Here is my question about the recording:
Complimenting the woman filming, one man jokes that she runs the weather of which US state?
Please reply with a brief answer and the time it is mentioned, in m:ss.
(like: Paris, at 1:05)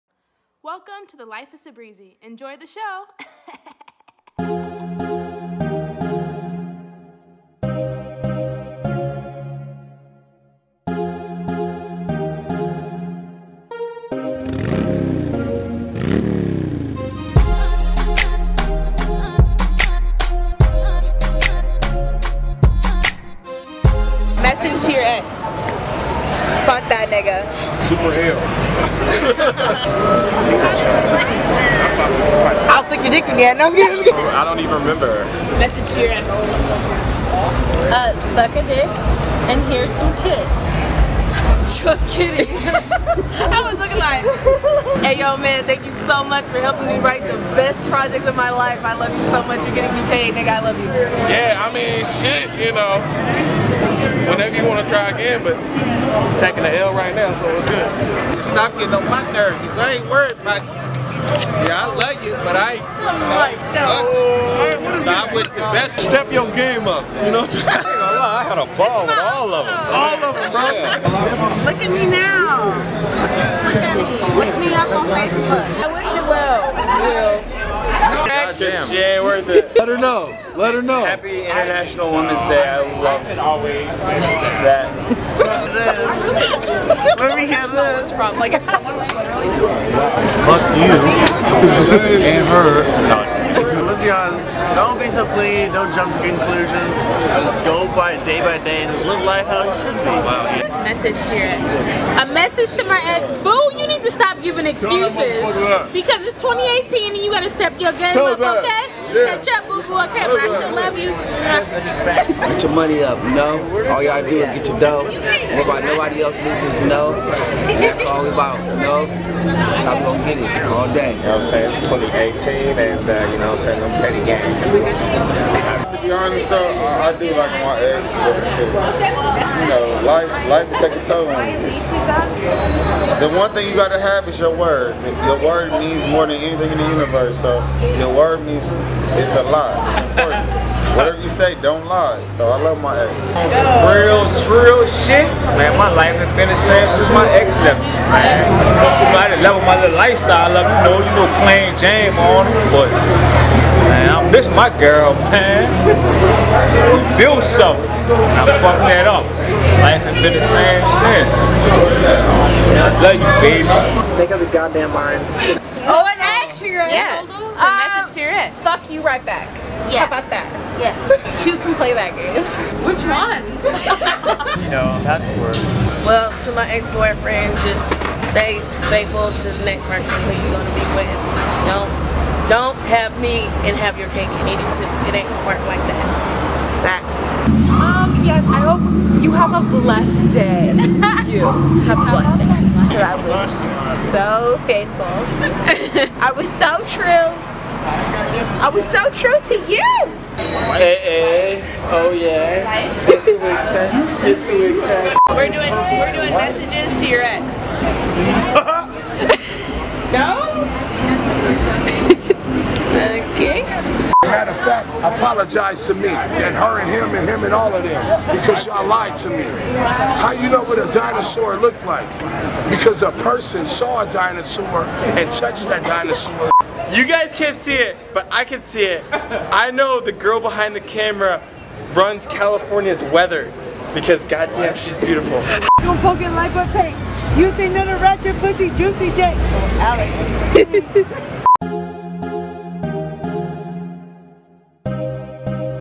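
California, at 3:52.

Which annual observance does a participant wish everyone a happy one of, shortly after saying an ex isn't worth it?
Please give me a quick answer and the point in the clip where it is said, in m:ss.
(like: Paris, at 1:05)
International Women's Day, at 1:21.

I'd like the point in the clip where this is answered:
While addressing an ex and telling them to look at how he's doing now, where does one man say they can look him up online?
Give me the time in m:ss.
1:15.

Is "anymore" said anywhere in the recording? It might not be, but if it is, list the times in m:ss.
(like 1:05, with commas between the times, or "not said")
not said.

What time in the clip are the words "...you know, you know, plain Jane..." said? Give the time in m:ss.
2:30.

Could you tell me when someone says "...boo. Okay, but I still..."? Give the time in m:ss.
1:49.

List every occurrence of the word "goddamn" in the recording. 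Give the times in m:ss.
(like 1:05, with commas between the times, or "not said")
2:44, 3:54.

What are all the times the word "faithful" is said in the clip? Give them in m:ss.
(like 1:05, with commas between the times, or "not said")
2:58, 3:14.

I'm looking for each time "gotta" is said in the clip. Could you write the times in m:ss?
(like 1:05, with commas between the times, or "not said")
1:47, 2:13.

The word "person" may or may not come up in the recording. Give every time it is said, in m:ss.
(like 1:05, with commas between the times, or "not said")
2:59, 3:43.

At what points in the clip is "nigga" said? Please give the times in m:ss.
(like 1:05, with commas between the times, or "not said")
0:27, 0:50.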